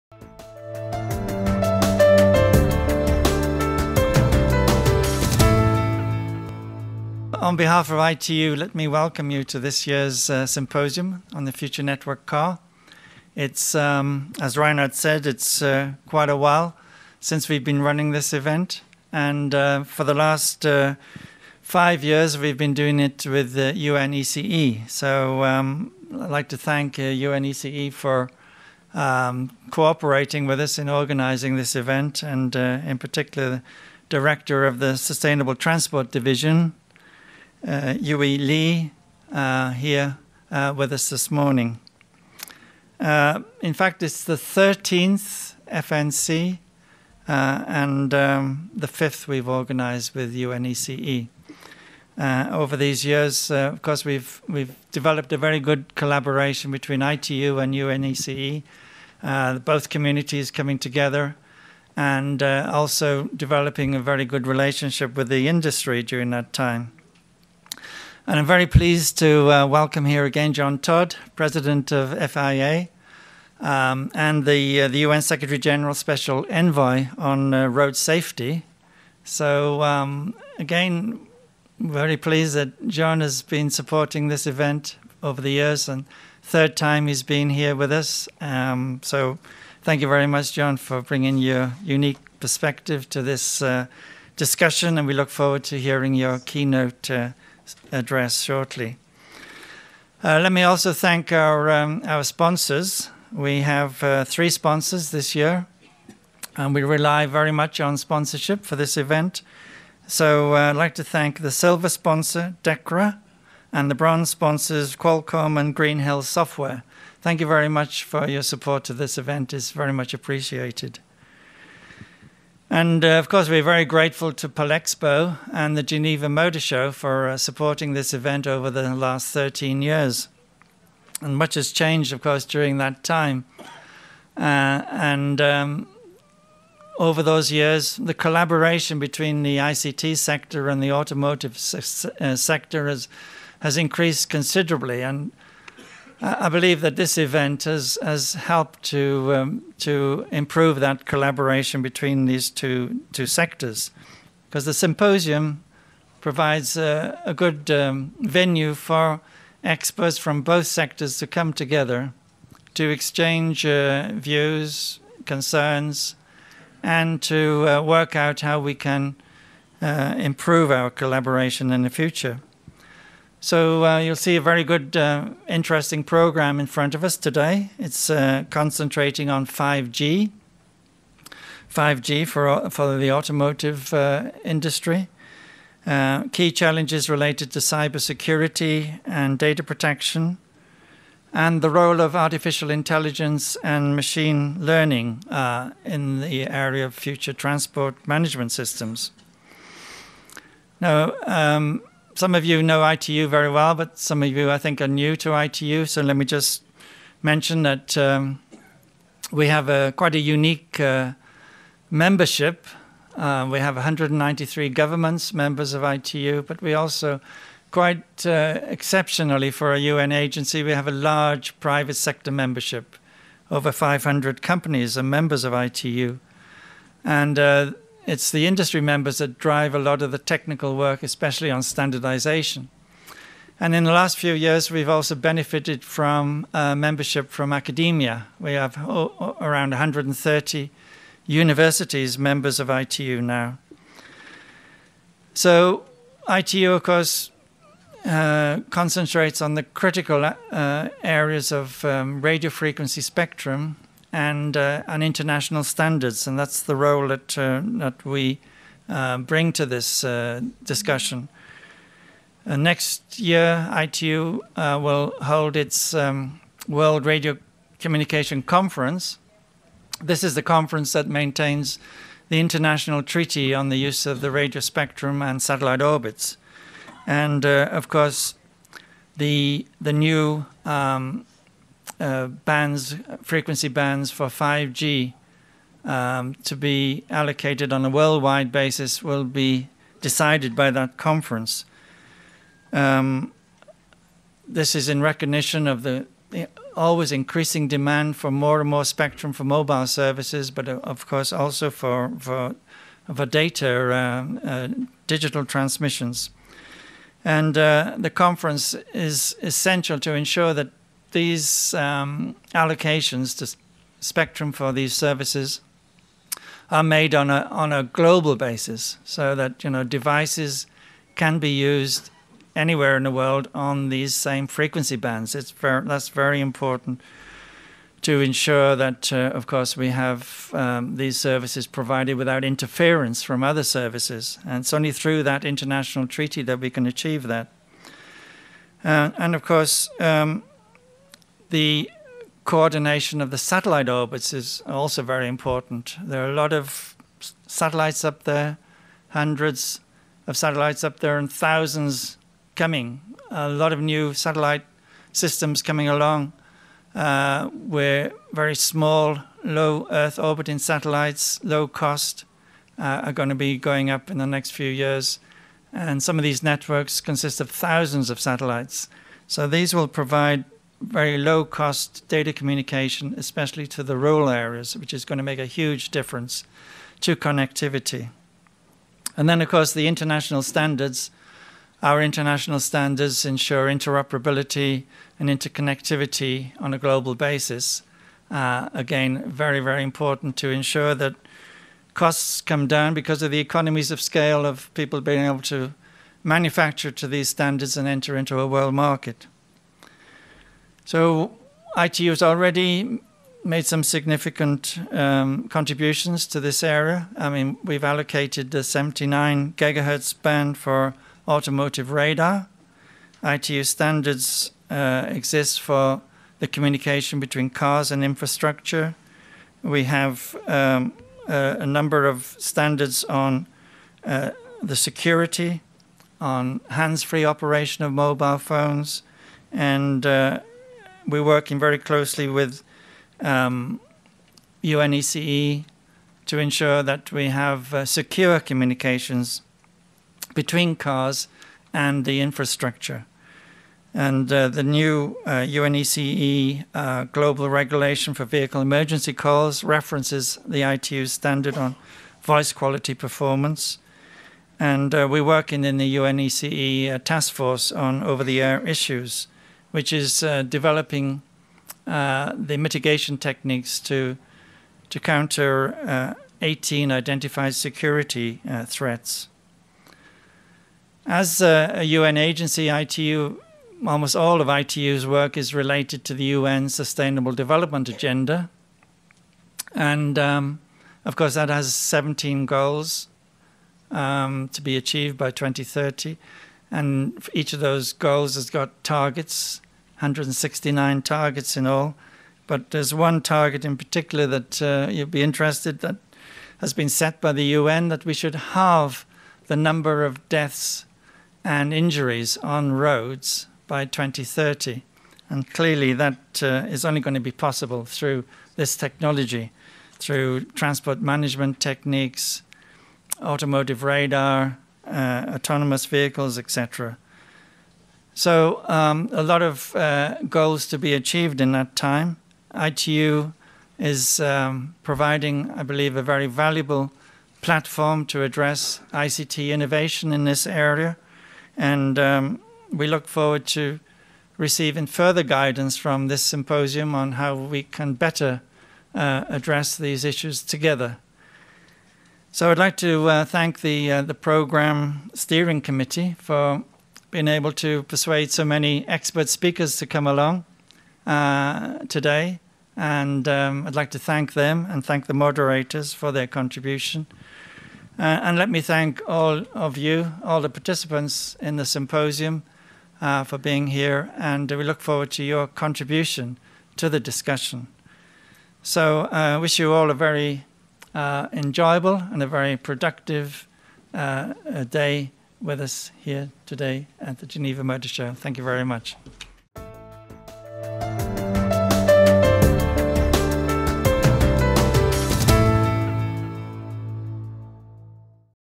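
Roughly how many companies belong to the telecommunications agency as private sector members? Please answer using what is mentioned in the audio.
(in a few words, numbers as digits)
Over 500.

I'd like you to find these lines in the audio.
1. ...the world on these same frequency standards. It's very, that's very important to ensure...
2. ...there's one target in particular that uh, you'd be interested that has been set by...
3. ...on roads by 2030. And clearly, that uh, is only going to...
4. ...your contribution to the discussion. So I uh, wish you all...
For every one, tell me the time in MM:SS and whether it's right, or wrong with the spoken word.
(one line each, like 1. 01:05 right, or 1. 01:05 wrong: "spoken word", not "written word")
1. 05:23 wrong: "bands", not "standards"
2. 08:12 right
3. 08:22 right
4. 09:25 right.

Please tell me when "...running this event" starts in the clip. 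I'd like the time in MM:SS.
00:17.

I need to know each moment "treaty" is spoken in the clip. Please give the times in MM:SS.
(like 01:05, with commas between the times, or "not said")
04:33, 05:36.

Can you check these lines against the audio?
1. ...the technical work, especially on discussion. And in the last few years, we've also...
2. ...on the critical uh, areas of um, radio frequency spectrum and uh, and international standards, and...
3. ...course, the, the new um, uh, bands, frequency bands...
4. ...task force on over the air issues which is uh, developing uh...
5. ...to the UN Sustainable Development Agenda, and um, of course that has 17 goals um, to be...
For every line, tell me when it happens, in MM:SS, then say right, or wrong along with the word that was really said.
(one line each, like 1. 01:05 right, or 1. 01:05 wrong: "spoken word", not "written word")
1. 03:50 wrong: "standardization", not "discussion"
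2. 04:09 right
3. 04:37 right
4. 07:36 right
5. 07:56 right.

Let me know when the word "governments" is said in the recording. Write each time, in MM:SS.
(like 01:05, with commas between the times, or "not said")
03:34.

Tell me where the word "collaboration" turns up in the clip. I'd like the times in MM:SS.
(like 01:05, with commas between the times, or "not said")
00:55, 02:18, 02:31, 02:50.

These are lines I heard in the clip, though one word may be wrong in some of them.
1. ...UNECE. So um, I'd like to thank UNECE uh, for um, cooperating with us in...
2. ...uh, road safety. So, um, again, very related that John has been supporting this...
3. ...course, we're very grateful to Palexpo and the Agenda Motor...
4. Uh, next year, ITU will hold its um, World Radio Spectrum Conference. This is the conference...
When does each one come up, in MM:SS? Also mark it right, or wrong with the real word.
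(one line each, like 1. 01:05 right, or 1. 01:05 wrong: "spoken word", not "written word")
1. 00:23 right
2. 01:17 wrong: "pleased", not "related"
3. 02:03 wrong: "Geneva", not "Agenda"
4. 04:22 wrong: "Communication", not "Spectrum".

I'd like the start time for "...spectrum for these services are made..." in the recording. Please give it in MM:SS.
05:13.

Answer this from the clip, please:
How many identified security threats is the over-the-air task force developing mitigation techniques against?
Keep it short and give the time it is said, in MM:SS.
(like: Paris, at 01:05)
18, at 07:46.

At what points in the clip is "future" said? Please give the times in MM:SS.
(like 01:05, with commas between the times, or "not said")
00:11, 02:51, 03:16.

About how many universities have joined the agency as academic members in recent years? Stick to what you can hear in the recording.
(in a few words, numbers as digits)
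130.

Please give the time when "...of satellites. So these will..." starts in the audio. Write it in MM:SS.
06:08.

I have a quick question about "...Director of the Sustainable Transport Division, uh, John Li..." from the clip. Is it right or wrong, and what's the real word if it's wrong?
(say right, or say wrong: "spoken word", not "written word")
wrong: "Yuwei", not "John".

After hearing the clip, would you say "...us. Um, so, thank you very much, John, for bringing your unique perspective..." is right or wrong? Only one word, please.
right.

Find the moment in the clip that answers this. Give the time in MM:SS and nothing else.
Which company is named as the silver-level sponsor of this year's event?
01:52.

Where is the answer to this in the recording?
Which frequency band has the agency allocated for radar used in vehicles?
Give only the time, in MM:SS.
06:48.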